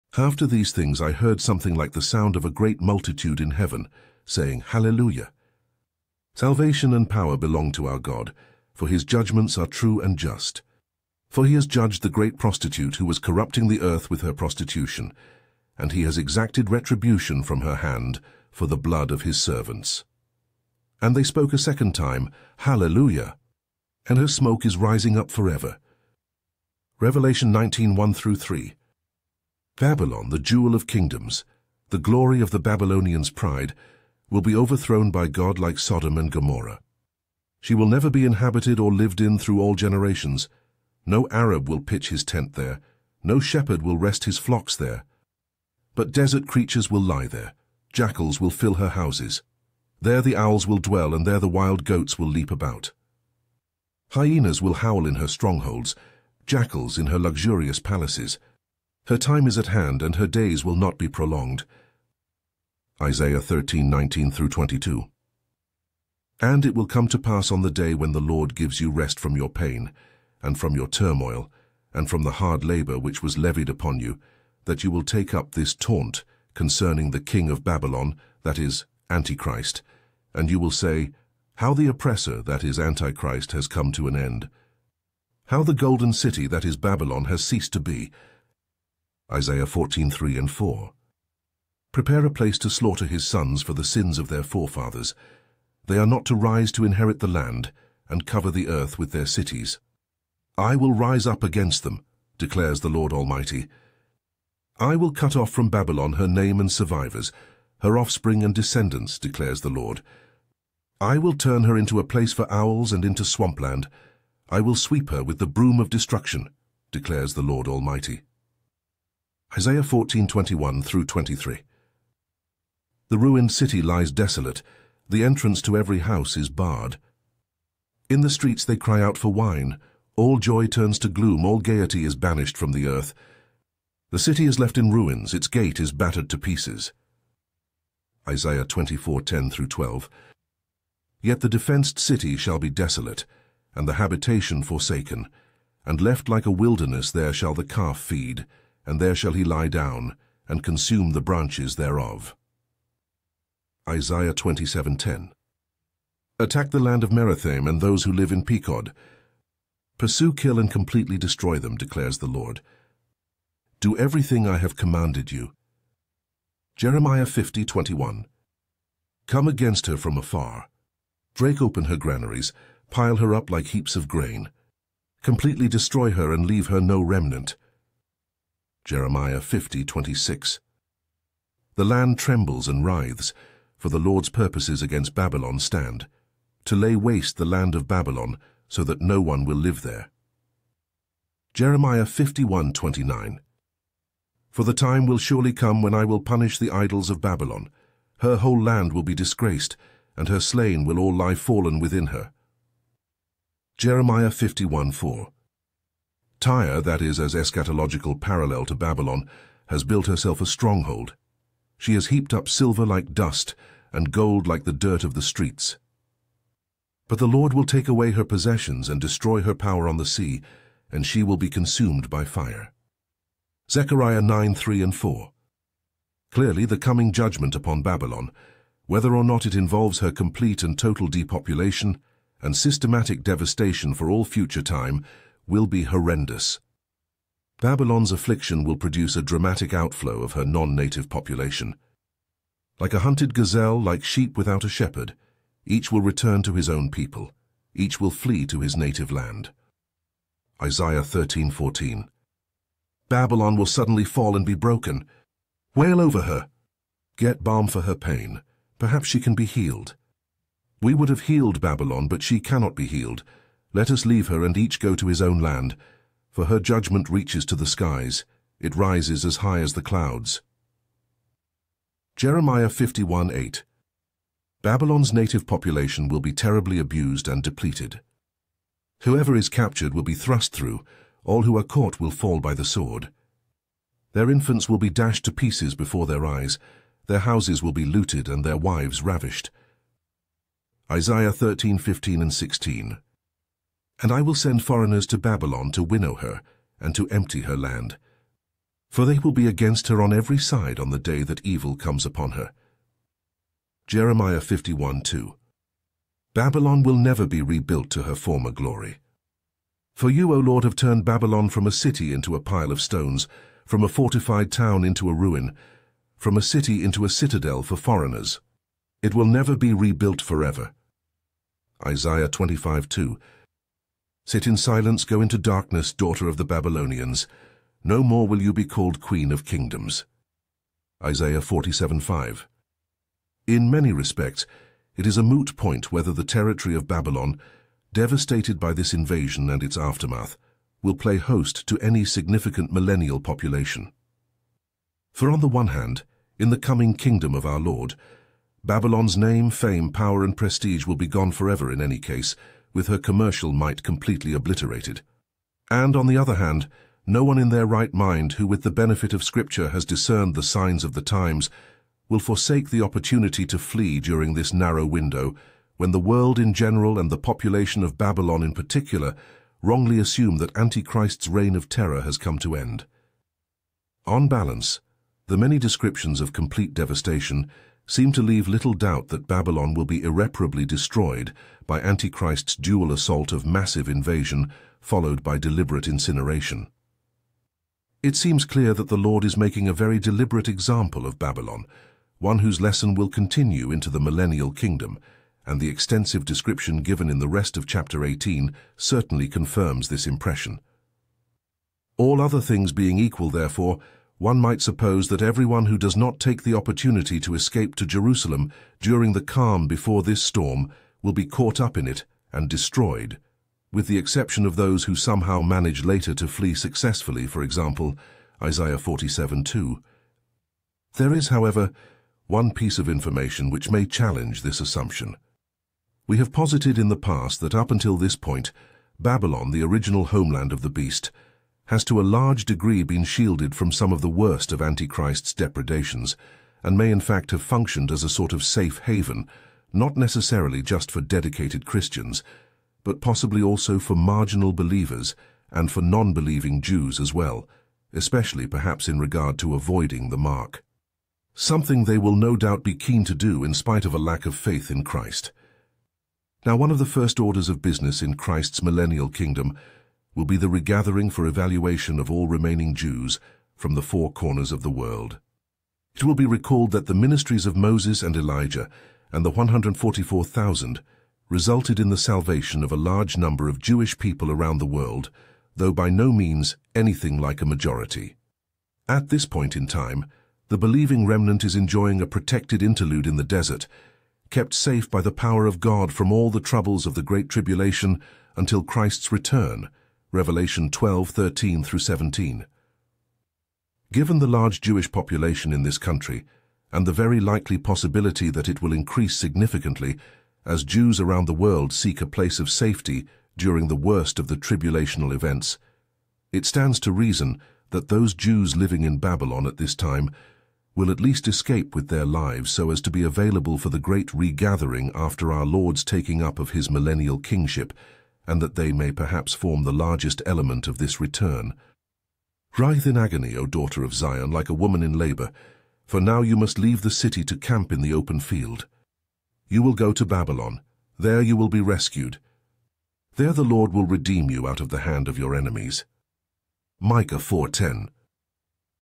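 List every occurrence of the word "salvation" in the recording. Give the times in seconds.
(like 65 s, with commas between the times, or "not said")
6 s, 471 s.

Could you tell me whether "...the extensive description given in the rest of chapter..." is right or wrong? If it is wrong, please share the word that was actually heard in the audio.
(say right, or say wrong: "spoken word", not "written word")
right.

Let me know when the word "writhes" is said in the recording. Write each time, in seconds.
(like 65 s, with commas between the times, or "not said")
182 s, 522 s.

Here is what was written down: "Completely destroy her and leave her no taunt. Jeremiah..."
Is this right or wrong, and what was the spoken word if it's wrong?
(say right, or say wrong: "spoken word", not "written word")
wrong: "remnant", not "taunt".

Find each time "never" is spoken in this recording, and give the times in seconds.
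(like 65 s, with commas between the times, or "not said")
37 s, 306 s, 319 s.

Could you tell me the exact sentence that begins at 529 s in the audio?
You will go to Babylon, there you will be rescued.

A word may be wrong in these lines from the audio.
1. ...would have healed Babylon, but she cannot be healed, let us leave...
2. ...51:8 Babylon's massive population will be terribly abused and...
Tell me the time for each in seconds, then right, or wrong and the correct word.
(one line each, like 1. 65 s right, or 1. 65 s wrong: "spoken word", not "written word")
1. 260 s right
2. 272 s wrong: "native", not "massive".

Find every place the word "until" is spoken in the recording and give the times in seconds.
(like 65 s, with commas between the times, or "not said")
427 s, 488 s.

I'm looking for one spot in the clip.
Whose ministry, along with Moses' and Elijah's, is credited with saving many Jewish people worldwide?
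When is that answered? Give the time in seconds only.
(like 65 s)
469 s.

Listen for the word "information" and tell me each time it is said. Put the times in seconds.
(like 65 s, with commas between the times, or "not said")
422 s.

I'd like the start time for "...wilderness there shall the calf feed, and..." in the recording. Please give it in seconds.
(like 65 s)
146 s.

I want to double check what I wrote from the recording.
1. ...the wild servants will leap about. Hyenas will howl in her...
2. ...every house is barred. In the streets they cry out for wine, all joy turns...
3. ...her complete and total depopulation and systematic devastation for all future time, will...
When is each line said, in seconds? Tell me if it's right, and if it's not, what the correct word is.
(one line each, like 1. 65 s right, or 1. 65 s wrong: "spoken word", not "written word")
1. 51 s wrong: "goats", not "servants"
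2. 125 s right
3. 229 s right.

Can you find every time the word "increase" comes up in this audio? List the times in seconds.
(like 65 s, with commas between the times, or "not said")
498 s.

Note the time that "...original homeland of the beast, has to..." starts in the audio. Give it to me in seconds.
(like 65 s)
429 s.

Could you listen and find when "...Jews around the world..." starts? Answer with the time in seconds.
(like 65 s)
500 s.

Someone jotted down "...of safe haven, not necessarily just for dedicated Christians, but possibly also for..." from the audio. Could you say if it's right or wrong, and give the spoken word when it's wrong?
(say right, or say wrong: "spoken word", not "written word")
right.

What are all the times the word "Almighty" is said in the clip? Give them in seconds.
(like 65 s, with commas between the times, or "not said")
103 s, 117 s.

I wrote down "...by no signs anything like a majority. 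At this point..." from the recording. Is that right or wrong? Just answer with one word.
wrong.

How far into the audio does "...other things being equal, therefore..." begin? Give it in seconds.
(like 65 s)
402 s.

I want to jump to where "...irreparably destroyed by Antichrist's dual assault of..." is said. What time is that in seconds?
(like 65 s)
380 s.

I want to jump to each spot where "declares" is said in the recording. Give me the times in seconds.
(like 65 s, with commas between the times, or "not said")
102 s, 109 s, 116 s, 161 s.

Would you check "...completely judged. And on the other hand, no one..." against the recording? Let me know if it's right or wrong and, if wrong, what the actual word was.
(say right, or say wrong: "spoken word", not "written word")
wrong: "obliterated", not "judged".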